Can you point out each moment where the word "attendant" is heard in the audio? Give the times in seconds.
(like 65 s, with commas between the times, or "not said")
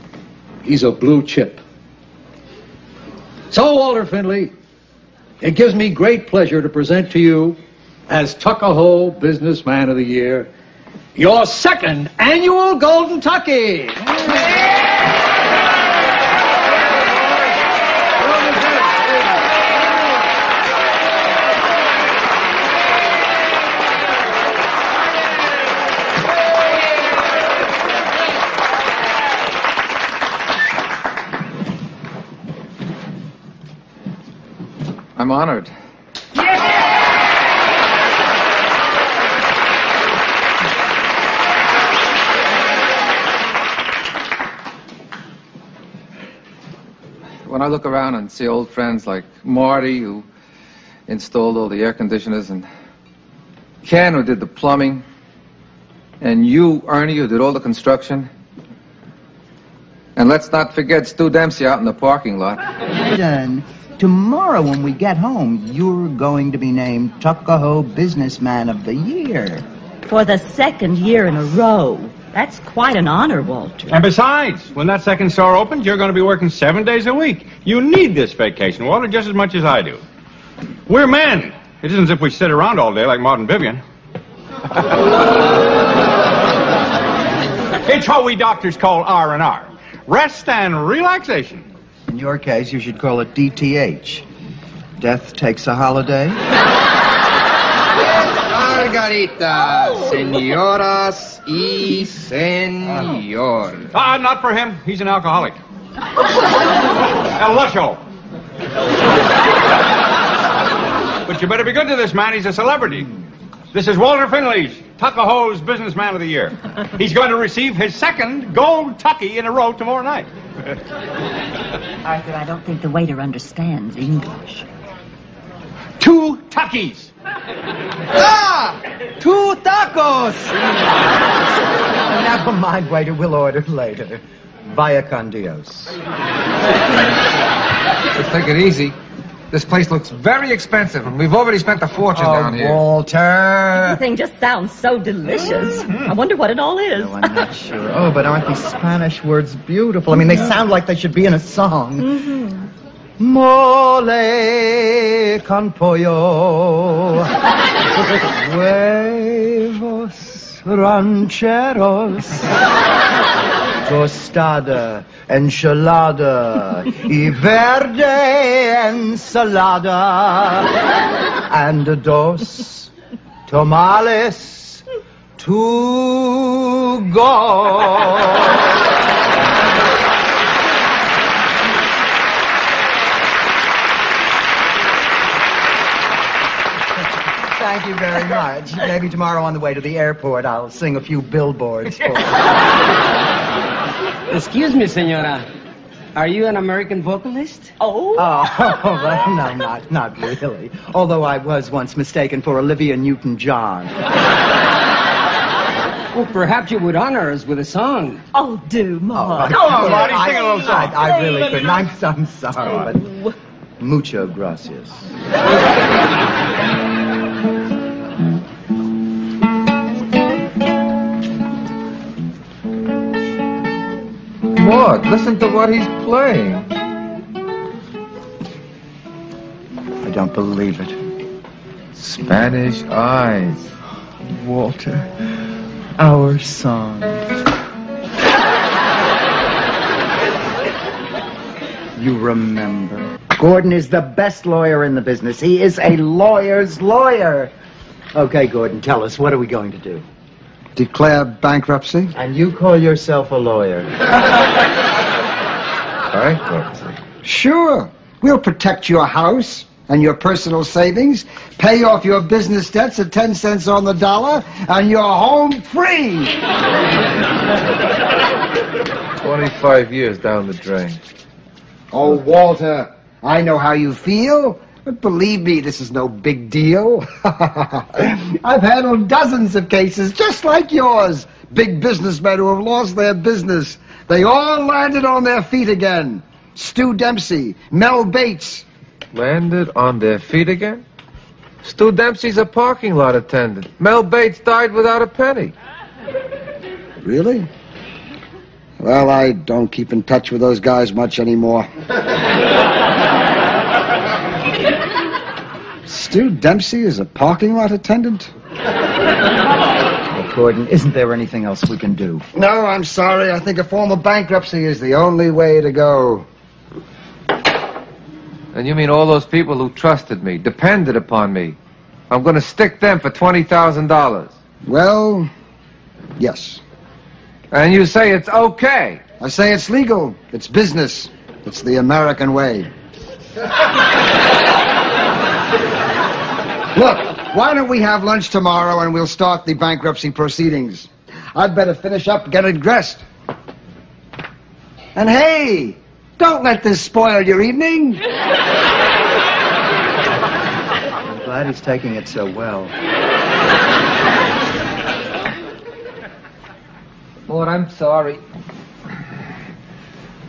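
293 s, 307 s.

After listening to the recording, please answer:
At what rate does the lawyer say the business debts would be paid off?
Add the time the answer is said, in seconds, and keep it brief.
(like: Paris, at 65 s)
10 cents on the dollar, at 263 s.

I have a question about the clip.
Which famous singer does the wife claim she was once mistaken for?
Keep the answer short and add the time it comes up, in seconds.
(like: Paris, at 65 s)
Olivia Newton-John, at 202 s.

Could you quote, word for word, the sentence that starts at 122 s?
Arthur, I don't think the waiter understands English.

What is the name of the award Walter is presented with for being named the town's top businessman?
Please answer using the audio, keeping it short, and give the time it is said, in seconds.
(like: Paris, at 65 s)
Golden Tucky, at 12 s.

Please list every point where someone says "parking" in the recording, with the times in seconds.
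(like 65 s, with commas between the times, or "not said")
61 s, 292 s, 307 s.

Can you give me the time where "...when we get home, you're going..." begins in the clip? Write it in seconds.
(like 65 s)
64 s.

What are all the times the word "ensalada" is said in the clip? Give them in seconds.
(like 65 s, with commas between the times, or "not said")
168 s.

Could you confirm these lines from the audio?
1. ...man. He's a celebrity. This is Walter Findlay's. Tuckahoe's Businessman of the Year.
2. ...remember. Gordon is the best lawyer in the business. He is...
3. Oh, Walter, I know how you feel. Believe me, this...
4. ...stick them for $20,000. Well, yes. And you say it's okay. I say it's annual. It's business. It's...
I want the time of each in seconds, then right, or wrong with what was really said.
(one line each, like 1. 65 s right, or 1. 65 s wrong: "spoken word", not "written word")
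1. 112 s right
2. 242 s right
3. 271 s right
4. 322 s wrong: "legal", not "annual".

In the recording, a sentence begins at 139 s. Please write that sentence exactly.
This place looks very expensive, and we've already spent a fortune oh, down here.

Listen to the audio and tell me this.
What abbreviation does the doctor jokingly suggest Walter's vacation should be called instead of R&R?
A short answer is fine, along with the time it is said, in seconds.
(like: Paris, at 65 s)
DTH, at 93 s.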